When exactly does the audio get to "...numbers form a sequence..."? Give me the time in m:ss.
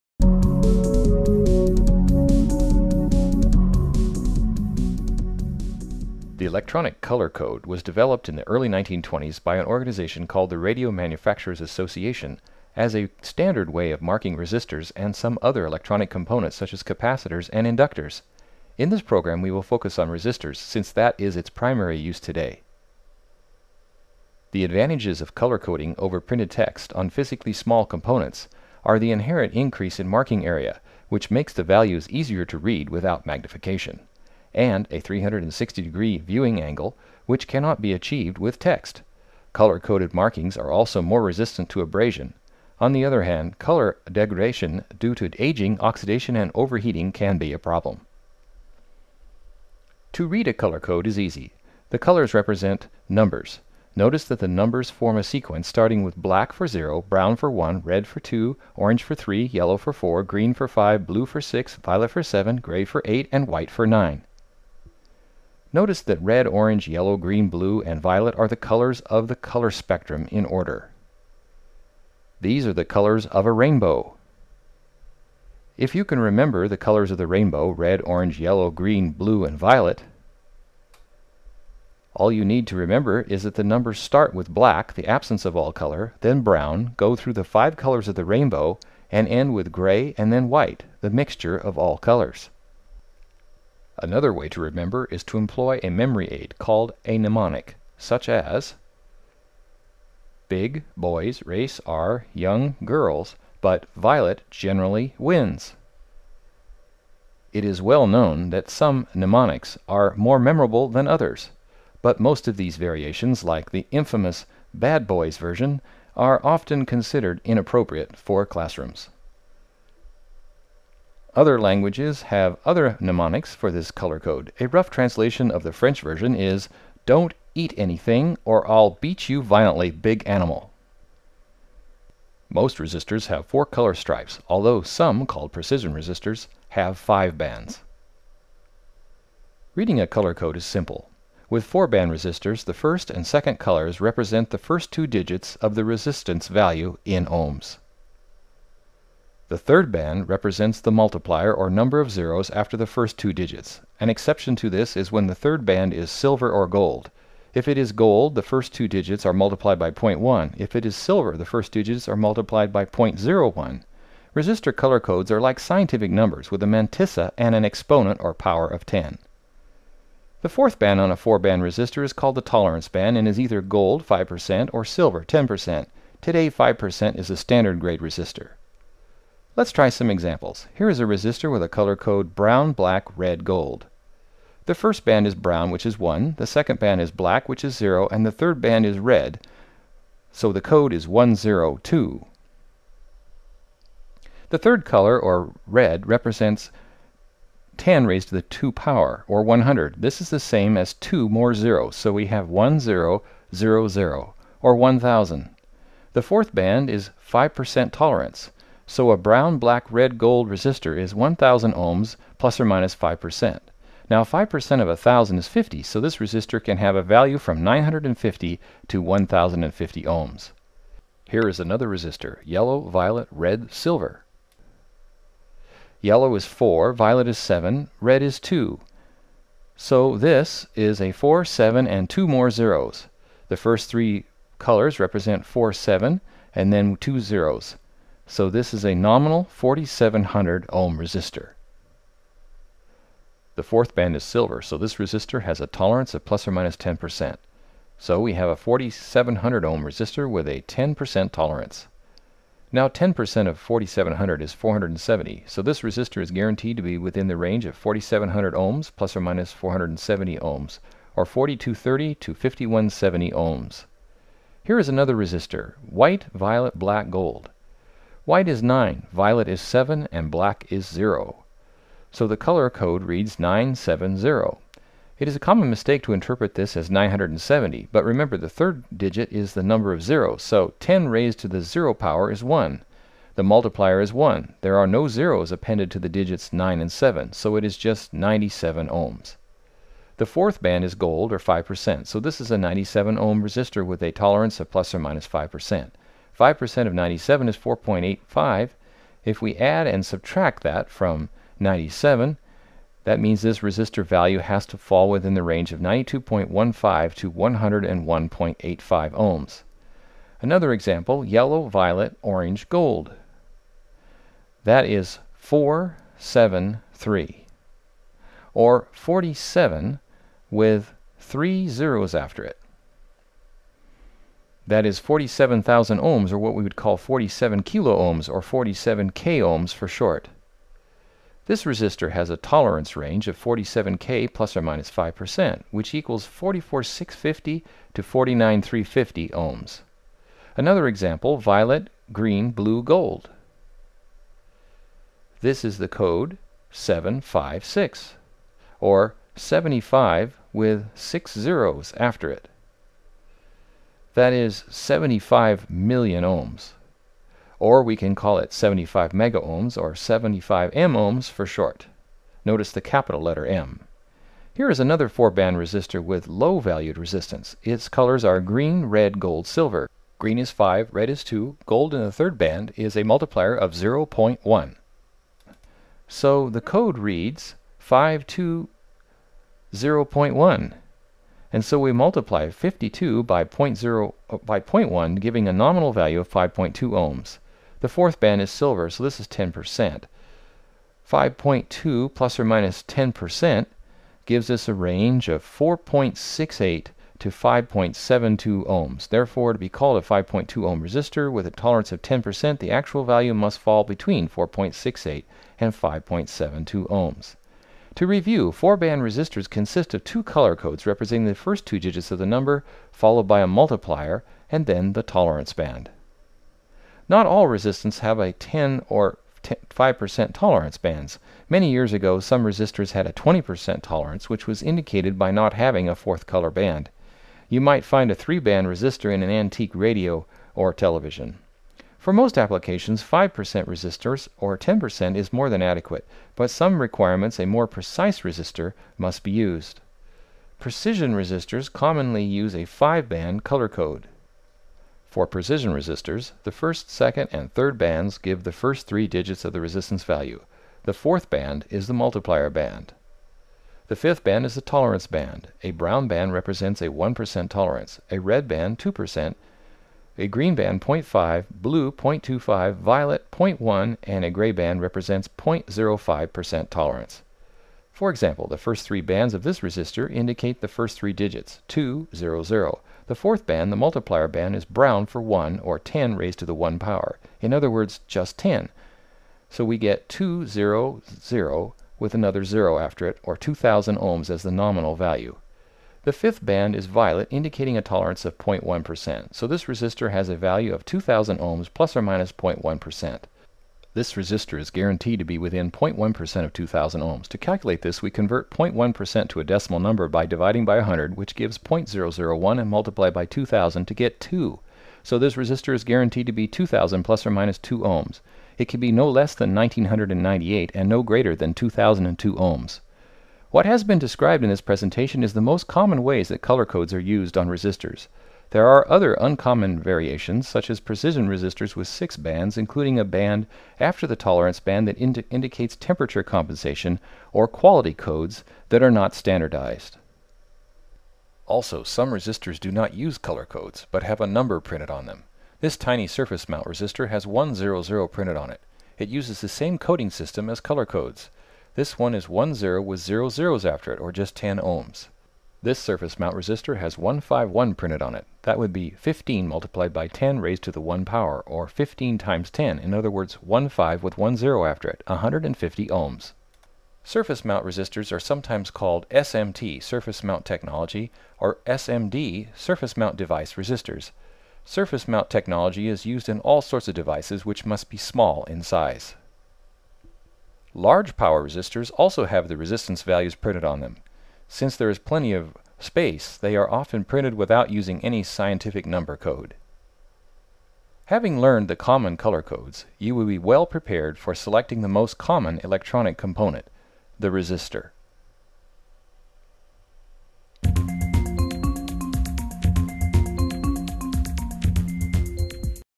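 0:54.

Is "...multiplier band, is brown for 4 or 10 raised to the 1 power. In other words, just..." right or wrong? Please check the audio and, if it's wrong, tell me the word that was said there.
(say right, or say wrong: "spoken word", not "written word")
wrong: "1", not "4".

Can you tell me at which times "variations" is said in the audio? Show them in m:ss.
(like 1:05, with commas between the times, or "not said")
1:52, 8:39.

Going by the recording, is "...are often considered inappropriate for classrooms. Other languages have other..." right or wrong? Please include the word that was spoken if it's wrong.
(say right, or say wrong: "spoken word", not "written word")
right.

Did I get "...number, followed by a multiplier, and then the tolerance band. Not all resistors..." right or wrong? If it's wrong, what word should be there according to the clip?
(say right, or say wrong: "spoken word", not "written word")
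right.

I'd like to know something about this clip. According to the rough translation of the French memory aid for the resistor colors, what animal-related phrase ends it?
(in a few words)
big animal.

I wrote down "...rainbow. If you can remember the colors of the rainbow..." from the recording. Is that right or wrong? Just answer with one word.
right.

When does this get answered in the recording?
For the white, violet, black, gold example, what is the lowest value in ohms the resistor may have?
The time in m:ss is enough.
5:05.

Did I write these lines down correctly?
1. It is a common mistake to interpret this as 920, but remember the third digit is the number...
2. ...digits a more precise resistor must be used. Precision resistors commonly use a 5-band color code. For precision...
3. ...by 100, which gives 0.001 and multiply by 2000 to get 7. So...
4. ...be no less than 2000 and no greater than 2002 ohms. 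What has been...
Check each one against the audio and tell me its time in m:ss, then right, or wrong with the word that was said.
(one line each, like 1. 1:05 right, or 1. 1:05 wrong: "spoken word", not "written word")
1. 4:35 wrong: "970", not "920"
2. 7:16 wrong: "requirements", not "digits"
3. 8:20 wrong: "2", not "7"
4. 8:28 wrong: "1998", not "2000".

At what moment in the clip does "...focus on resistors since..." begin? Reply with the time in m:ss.
0:19.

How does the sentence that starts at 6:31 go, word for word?
5.2 plus or minus 10% gives us a range of 4.68 to 5.72 ohms.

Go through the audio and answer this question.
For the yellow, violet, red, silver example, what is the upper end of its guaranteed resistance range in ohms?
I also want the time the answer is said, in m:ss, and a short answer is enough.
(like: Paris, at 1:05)
5170, at 4:22.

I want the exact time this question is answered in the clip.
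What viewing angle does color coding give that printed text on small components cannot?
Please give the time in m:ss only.
0:34.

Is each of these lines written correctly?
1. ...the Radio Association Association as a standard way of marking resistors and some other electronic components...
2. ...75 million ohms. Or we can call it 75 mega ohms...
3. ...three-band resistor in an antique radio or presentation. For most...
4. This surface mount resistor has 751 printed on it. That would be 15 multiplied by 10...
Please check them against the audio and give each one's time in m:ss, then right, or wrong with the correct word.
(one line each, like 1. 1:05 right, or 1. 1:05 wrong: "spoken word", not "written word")
1. 0:10 wrong: "Manufacturers", not "Association"
2. 5:54 right
3. 7:08 wrong: "television", not "presentation"
4. 9:05 wrong: "151", not "751".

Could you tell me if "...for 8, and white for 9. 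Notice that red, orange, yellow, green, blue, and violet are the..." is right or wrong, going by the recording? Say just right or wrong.
right.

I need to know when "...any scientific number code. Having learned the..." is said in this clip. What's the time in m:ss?
9:38.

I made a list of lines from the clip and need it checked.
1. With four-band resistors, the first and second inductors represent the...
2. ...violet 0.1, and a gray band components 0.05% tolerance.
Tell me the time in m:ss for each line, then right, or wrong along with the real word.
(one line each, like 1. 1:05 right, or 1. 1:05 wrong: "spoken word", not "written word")
1. 2:21 wrong: "colors", not "inductors"
2. 7:42 wrong: "represents", not "components".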